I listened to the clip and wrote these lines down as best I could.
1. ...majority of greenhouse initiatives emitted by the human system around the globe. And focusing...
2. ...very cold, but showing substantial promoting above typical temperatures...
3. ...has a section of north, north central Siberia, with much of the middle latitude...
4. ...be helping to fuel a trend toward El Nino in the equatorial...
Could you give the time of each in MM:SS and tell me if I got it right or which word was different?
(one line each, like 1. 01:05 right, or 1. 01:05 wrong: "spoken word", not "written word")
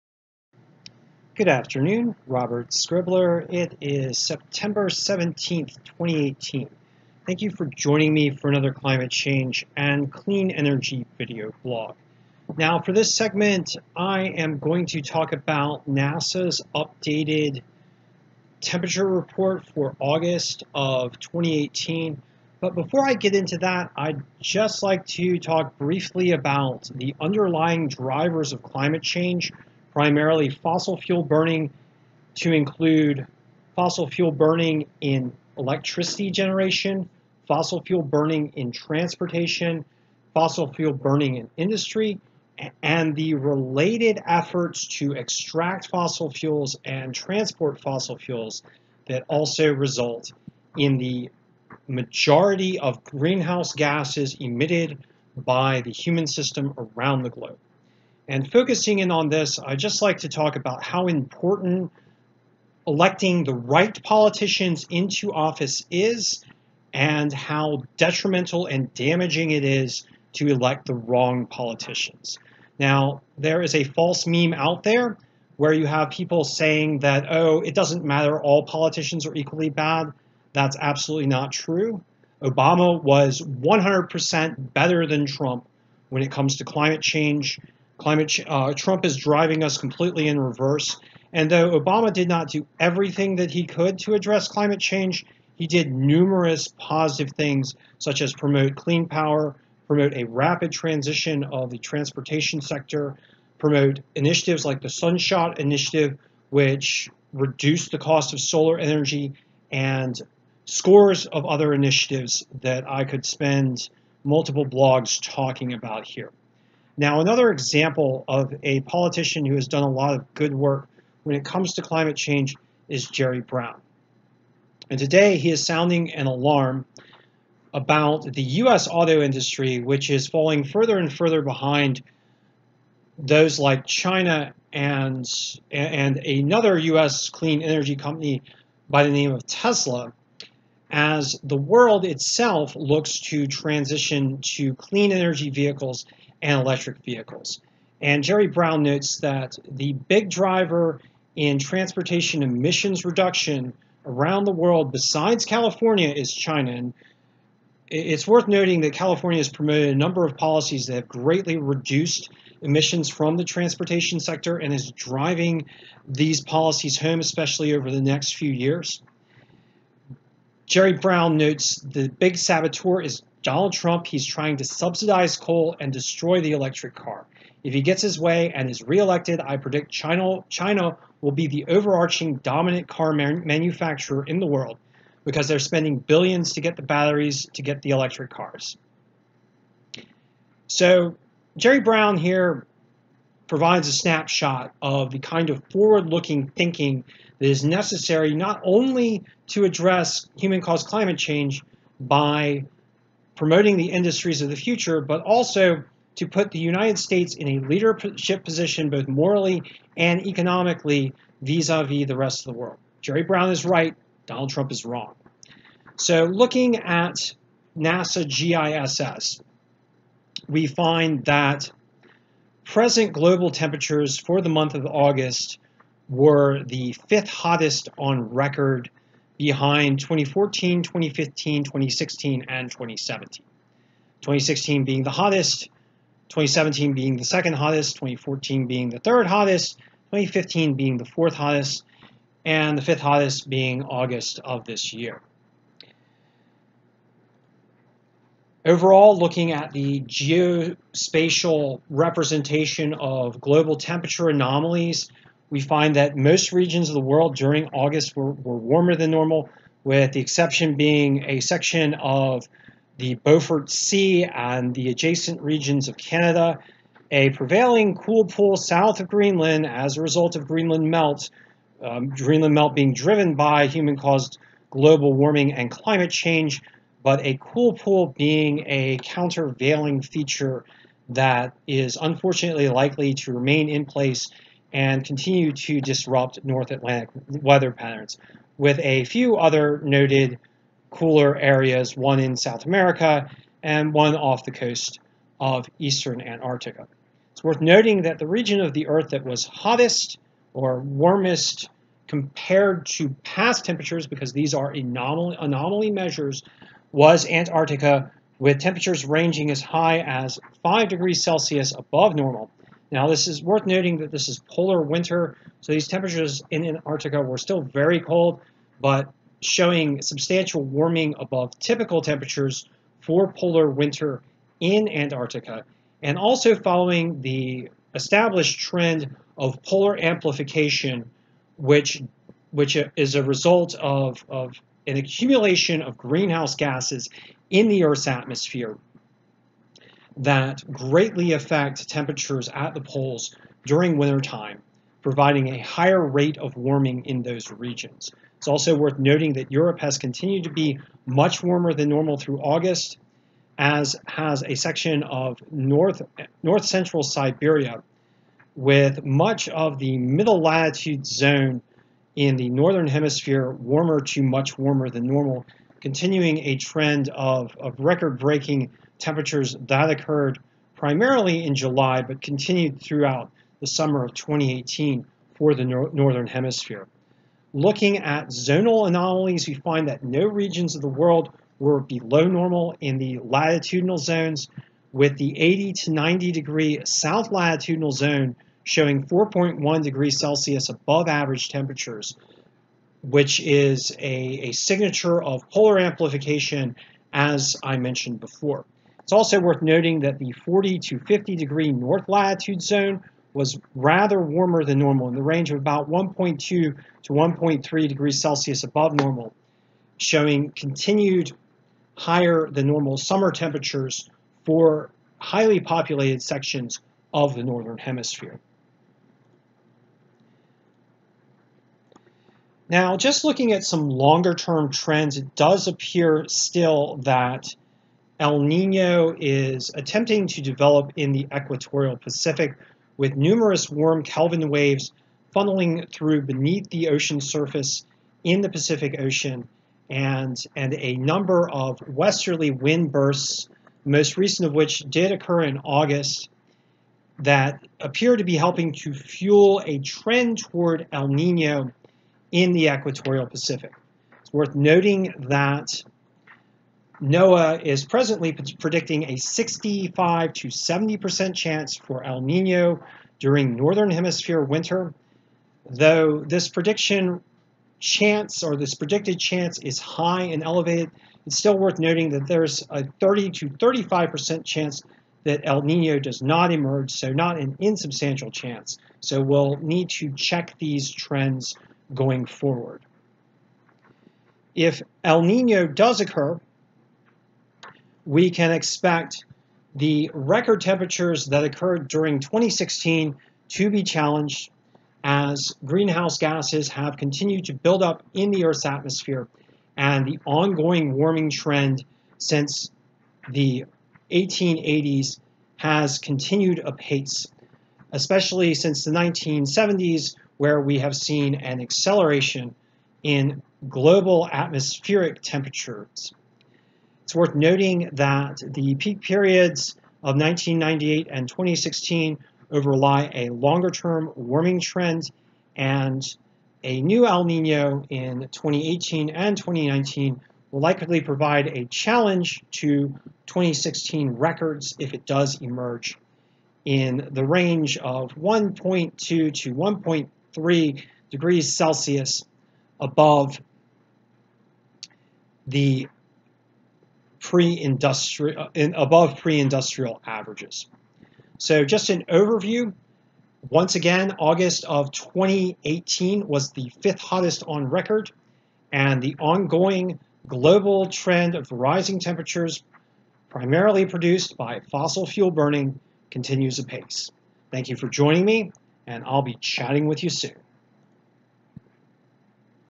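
1. 00:51 wrong: "gases", not "initiatives"
2. 05:17 wrong: "warming", not "promoting"
3. 05:54 right
4. 07:28 right.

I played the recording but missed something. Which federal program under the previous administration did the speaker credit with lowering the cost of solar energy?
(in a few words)
Sunshot Initiative.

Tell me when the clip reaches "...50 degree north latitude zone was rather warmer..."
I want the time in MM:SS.
06:40.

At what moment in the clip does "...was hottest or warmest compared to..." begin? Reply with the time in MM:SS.
04:59.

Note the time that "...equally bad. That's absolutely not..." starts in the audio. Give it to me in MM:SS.
01:19.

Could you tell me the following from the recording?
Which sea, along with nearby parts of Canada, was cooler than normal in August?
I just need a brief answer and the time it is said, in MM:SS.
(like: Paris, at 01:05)
Beaufort Sea, at 04:23.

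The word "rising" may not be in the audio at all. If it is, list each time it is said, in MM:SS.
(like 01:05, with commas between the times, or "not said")
09:21.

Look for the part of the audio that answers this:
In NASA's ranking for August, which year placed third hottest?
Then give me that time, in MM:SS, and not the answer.
03:57.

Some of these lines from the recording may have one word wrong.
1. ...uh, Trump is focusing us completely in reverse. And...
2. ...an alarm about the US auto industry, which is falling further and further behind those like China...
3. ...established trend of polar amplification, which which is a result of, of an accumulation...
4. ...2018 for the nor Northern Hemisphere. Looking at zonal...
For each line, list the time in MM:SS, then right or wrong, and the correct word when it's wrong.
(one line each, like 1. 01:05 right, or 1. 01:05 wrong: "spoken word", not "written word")
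1. 01:28 wrong: "driving", not "focusing"
2. 02:06 right
3. 05:27 right
4. 06:14 right.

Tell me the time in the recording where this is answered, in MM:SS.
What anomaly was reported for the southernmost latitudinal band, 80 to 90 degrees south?
06:29.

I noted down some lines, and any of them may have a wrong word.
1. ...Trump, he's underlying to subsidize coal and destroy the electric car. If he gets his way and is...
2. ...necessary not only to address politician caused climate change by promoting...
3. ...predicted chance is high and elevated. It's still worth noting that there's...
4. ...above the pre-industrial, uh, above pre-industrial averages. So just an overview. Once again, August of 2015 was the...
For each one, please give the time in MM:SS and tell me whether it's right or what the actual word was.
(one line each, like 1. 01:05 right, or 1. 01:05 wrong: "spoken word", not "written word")
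1. 02:53 wrong: "trying", not "underlying"
2. 03:17 wrong: "human", not "politician"
3. 07:48 right
4. 09:02 wrong: "2018", not "2015".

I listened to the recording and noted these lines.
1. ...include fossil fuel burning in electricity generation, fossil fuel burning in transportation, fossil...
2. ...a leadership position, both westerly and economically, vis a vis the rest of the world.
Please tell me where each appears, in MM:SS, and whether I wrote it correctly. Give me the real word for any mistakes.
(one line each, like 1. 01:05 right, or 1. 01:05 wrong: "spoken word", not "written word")
1. 00:32 right
2. 03:27 wrong: "morally", not "westerly".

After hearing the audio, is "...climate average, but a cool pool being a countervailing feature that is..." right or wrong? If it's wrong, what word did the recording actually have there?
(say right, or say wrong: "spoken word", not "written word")
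wrong: "change", not "average".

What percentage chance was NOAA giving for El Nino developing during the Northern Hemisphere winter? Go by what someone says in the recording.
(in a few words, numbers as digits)
65 to 70%.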